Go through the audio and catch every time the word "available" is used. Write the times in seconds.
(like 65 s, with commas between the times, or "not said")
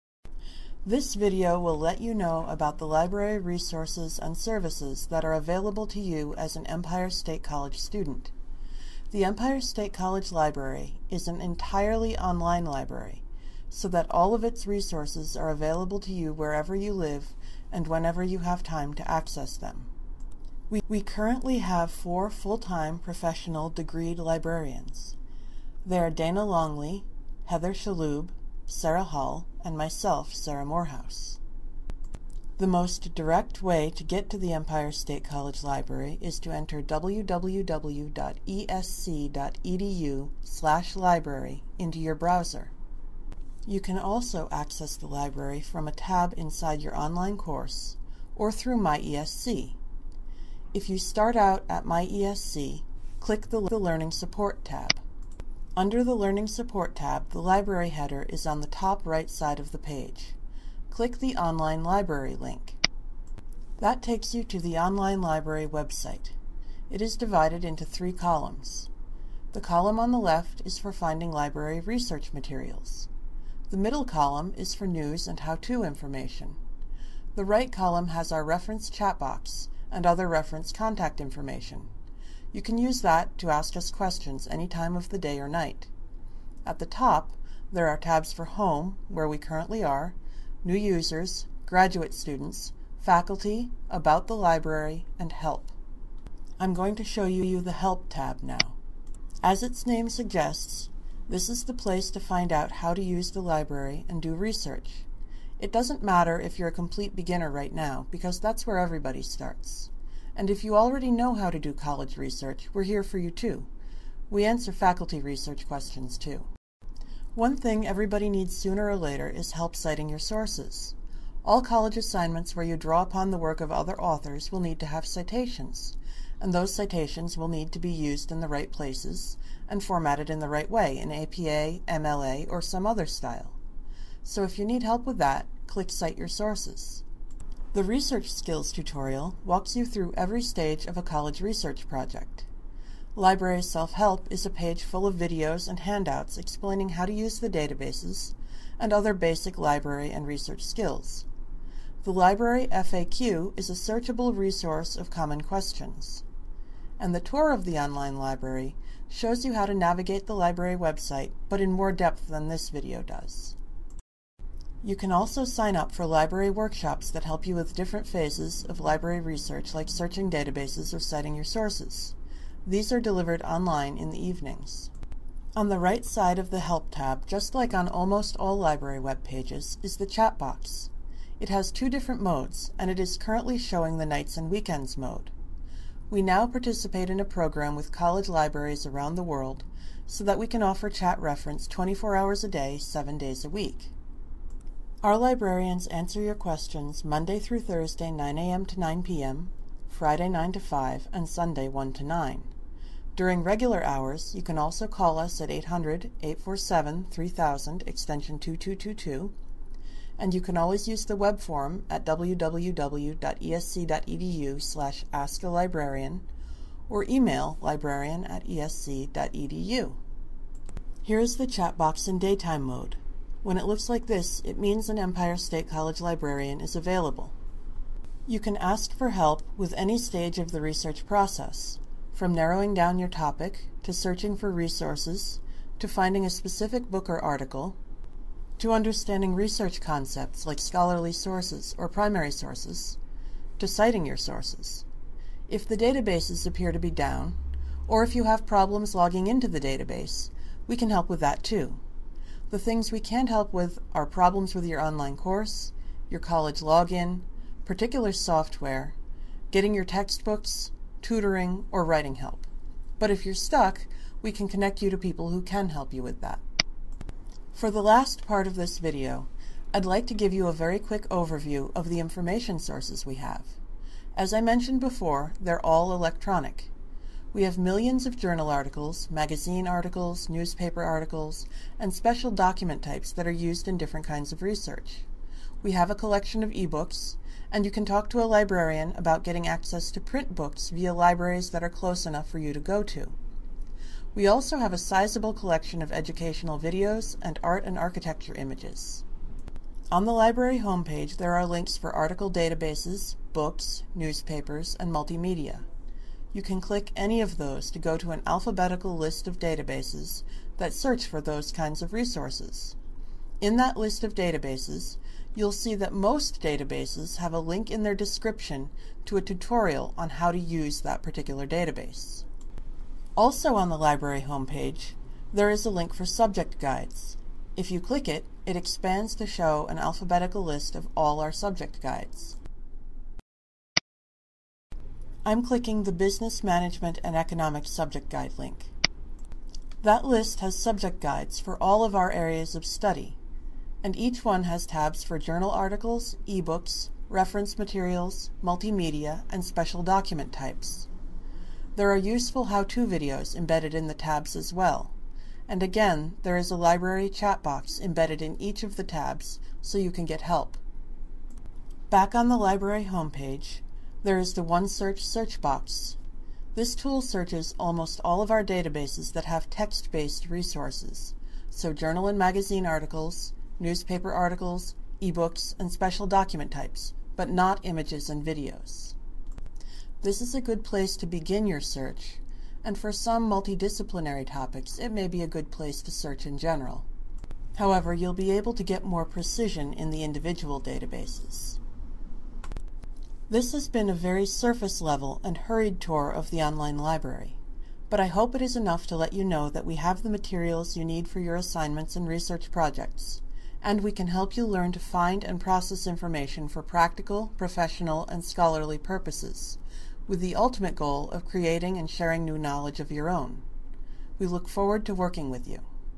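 5 s, 15 s, 226 s.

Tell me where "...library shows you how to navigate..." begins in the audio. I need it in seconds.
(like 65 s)
158 s.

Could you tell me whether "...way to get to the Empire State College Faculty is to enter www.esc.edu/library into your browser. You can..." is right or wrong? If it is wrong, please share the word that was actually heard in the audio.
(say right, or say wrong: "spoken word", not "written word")
wrong: "Library", not "Faculty".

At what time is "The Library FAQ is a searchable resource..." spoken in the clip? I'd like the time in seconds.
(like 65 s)
152 s.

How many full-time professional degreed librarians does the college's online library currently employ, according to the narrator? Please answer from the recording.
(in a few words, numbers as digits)
4.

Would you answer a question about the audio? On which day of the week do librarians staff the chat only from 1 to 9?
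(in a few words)
Sunday.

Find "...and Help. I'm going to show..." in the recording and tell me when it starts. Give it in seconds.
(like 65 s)
95 s.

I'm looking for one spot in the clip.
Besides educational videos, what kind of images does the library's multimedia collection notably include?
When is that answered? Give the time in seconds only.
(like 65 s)
297 s.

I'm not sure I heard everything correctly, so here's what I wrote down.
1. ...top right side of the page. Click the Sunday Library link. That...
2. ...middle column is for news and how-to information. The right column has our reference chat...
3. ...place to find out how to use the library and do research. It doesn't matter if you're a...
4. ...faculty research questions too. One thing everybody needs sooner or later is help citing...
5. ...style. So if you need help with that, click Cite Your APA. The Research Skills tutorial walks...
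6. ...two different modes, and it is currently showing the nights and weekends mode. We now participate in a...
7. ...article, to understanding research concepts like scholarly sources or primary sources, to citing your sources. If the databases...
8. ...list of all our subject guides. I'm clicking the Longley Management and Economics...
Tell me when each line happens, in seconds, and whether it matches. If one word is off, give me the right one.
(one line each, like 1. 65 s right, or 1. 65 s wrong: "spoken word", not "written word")
1. 58 s wrong: "Online", not "Sunday"
2. 73 s right
3. 101 s right
4. 114 s right
5. 133 s wrong: "Sources", not "APA"
6. 181 s right
7. 237 s right
8. 330 s wrong: "Business", not "Longley".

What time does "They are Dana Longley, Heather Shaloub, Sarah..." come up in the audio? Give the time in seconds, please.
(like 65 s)
25 s.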